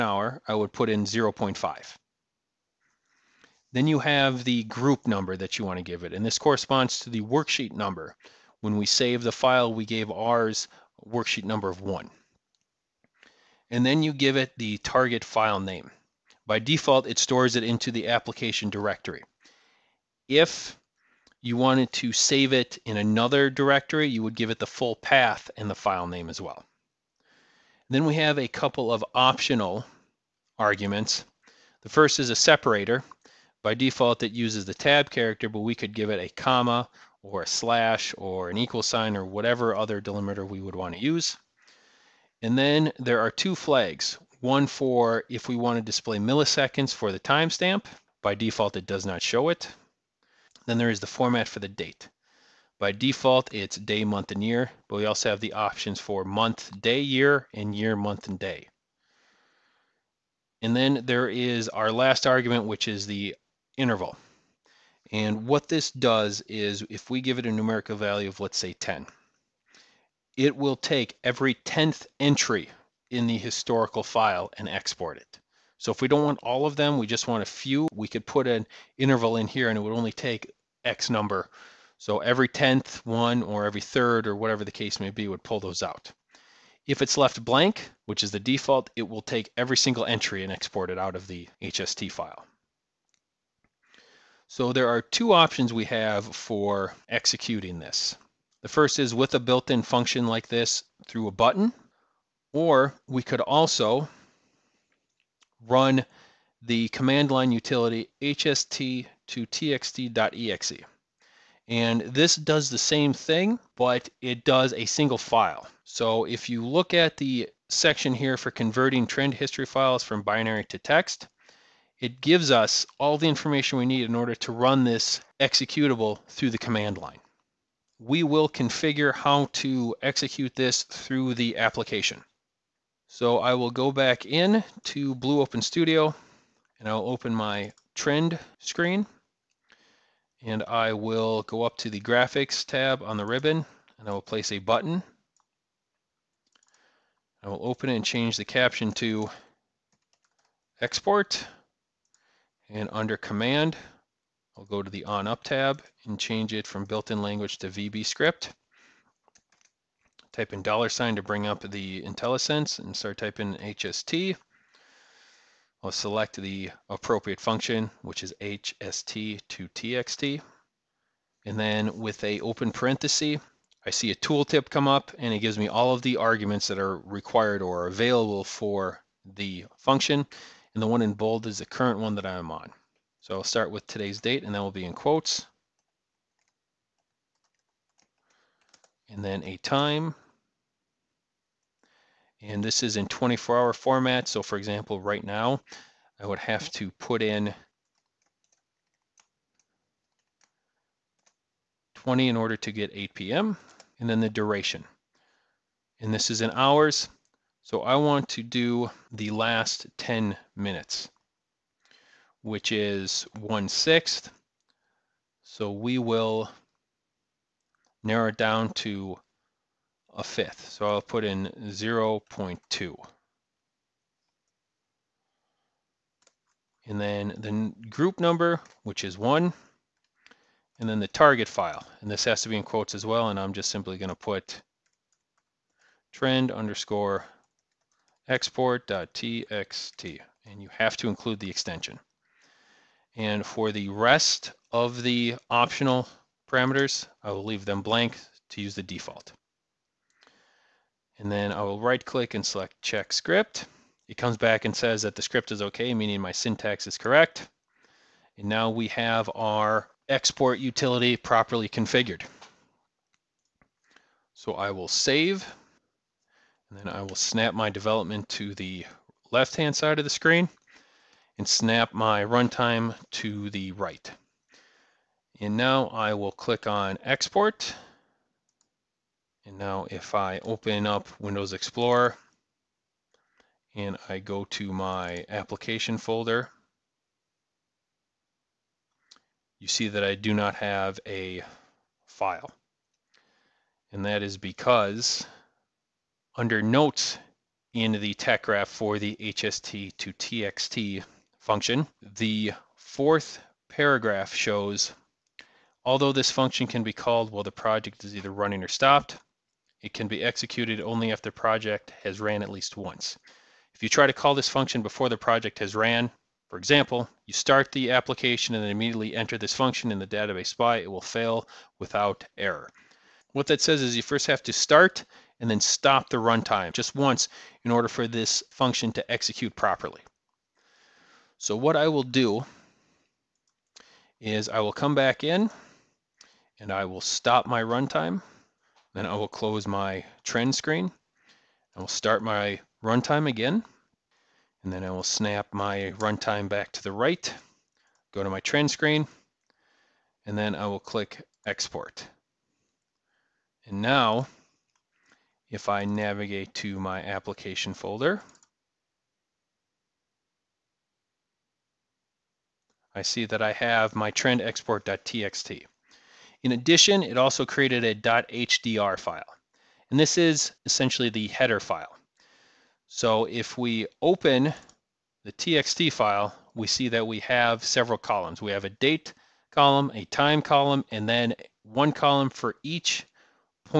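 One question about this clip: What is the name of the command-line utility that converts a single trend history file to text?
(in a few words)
hst to txt.exe.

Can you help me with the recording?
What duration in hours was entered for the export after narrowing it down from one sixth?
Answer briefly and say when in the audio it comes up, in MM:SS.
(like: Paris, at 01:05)
0.2, at 03:41.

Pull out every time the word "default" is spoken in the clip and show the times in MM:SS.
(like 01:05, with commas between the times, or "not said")
00:16, 00:33, 00:48, 00:52, 01:28, 04:08.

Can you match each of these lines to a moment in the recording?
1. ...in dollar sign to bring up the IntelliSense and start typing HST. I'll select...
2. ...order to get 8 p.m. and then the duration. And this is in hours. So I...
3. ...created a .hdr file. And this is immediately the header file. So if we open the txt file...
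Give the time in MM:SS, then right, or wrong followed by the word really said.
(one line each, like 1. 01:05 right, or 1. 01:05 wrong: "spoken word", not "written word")
1. 02:40 right
2. 03:22 right
3. 06:07 wrong: "essentially", not "immediately".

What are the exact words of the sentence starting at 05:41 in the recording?
I will start my runtime again.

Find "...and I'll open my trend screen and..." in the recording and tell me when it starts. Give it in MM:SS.
02:16.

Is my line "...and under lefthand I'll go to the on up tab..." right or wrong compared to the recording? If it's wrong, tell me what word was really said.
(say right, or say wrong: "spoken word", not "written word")
wrong: "command", not "lefthand".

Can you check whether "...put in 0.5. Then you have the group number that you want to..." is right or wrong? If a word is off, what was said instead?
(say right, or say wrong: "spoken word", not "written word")
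right.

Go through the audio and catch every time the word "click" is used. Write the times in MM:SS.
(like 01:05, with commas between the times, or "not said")
04:12, 04:36, 05:50.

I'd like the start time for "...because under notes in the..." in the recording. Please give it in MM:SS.
04:54.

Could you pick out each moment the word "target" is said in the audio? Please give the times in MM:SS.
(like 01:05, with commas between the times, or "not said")
00:14, 03:51.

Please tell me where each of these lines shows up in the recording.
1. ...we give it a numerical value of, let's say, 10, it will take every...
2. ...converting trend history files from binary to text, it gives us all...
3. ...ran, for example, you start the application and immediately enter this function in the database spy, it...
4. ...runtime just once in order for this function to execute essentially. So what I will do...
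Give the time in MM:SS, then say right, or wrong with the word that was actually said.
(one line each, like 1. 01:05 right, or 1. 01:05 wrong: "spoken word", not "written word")
1. 01:07 right
2. 01:58 right
3. 05:15 right
4. 05:26 wrong: "properly", not "essentially".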